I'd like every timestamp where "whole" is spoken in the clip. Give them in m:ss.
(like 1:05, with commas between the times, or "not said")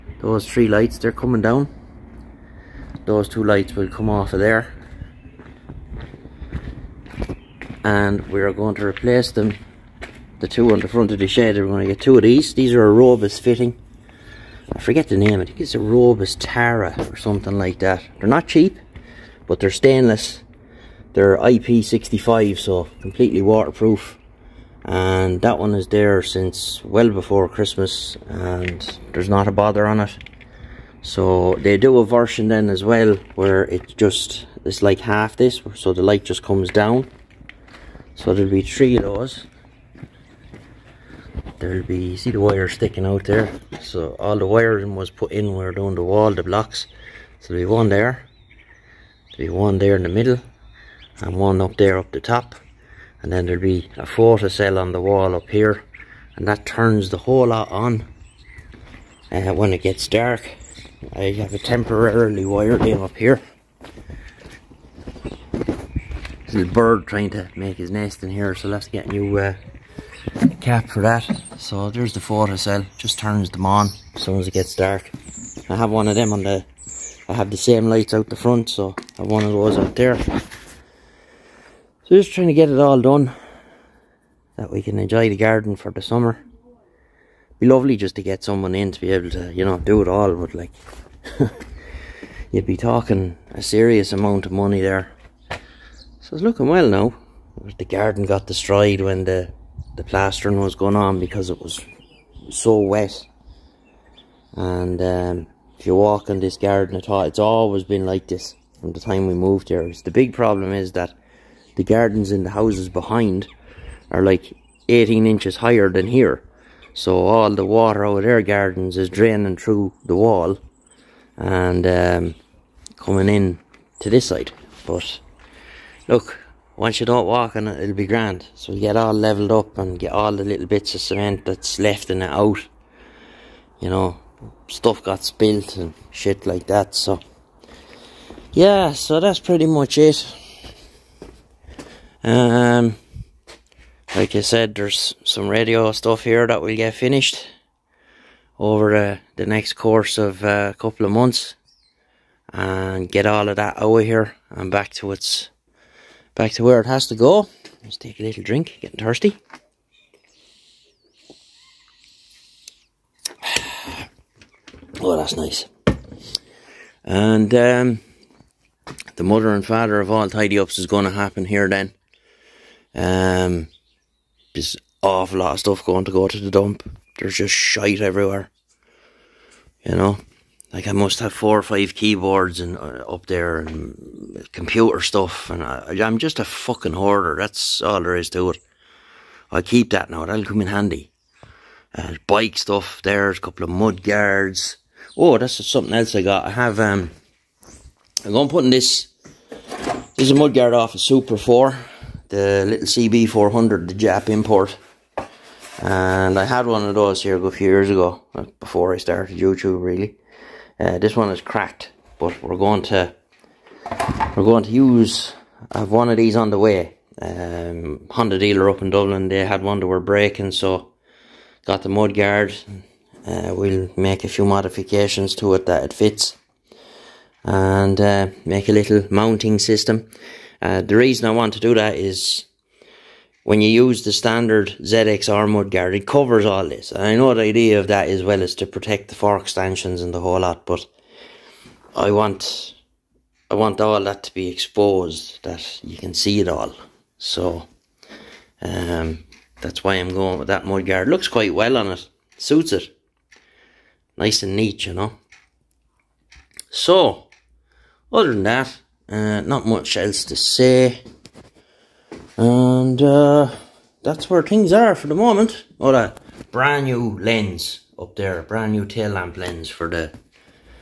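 0:57, 4:00.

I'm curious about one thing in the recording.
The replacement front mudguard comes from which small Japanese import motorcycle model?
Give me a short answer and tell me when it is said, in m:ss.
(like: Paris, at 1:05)
CB400, at 3:22.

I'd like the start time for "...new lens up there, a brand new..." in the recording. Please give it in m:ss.
4:26.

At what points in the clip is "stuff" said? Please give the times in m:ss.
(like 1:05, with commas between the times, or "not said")
2:14, 2:25, 2:55, 3:05, 3:12.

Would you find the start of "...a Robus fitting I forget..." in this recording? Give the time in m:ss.
0:12.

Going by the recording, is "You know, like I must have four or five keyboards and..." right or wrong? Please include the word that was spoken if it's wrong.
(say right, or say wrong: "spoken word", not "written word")
right.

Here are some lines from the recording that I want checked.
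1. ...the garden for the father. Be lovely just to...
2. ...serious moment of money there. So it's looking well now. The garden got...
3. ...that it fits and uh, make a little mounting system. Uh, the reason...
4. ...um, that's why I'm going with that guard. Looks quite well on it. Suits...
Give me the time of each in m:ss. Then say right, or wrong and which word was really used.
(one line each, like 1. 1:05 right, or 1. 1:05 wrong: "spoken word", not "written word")
1. 1:25 wrong: "summer", not "father"
2. 1:33 wrong: "amount", not "moment"
3. 3:45 right
4. 4:08 wrong: "mudguard", not "guard".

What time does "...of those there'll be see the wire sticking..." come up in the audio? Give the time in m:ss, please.
0:38.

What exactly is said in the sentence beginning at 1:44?
And um, if you walk in this garden at all, it's always been like this from the time we moved here.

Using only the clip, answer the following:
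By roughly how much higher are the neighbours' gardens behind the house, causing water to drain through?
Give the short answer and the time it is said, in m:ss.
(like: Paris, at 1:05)
18 inches, at 1:54.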